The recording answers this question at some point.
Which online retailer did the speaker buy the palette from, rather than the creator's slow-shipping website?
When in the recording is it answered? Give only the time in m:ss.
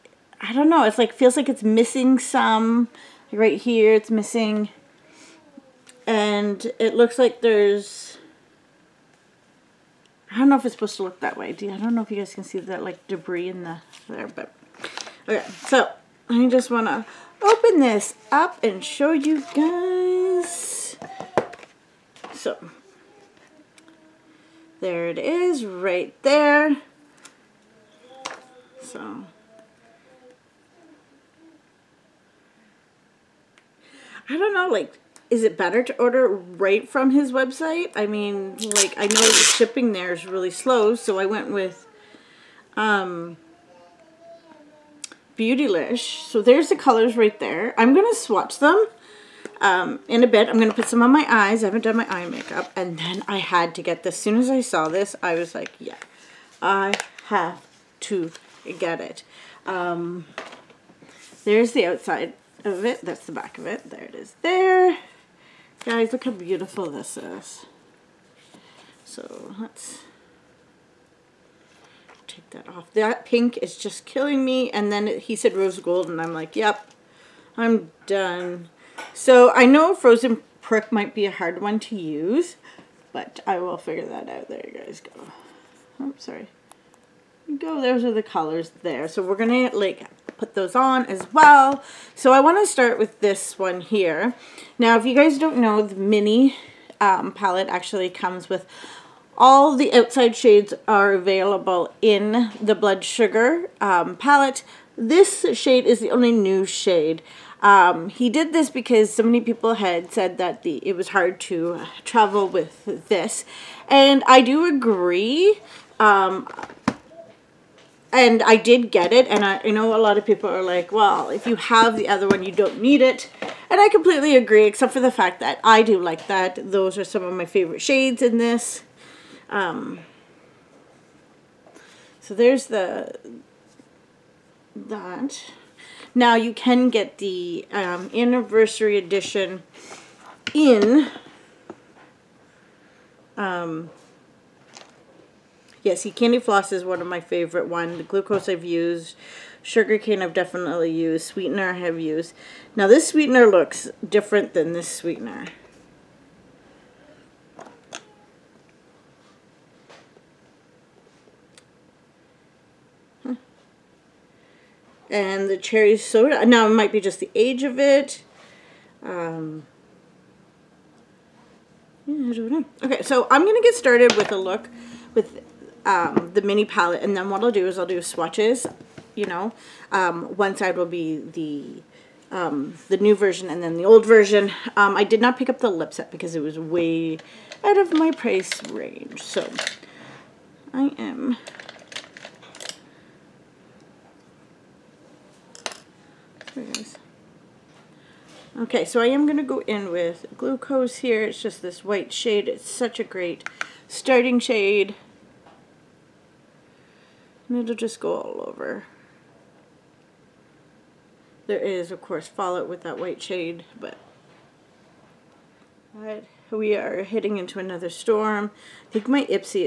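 0:45.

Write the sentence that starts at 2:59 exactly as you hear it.
Um, one side will be the um, the new version and then the old version.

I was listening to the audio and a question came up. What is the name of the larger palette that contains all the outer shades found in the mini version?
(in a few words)
Blood Sugar.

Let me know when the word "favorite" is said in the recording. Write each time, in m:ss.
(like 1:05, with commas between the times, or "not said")
2:07, 2:27.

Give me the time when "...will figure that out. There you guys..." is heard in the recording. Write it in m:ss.
1:23.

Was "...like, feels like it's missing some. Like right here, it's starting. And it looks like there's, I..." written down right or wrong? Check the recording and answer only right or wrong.
wrong.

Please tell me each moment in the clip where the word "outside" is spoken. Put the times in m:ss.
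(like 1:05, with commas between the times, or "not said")
1:01, 1:39.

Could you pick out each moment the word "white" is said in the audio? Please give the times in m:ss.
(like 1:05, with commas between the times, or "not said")
3:21, 3:32.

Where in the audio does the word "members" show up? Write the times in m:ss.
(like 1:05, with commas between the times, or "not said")
not said.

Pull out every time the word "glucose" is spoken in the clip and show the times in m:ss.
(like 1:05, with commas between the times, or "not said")
2:28, 3:20.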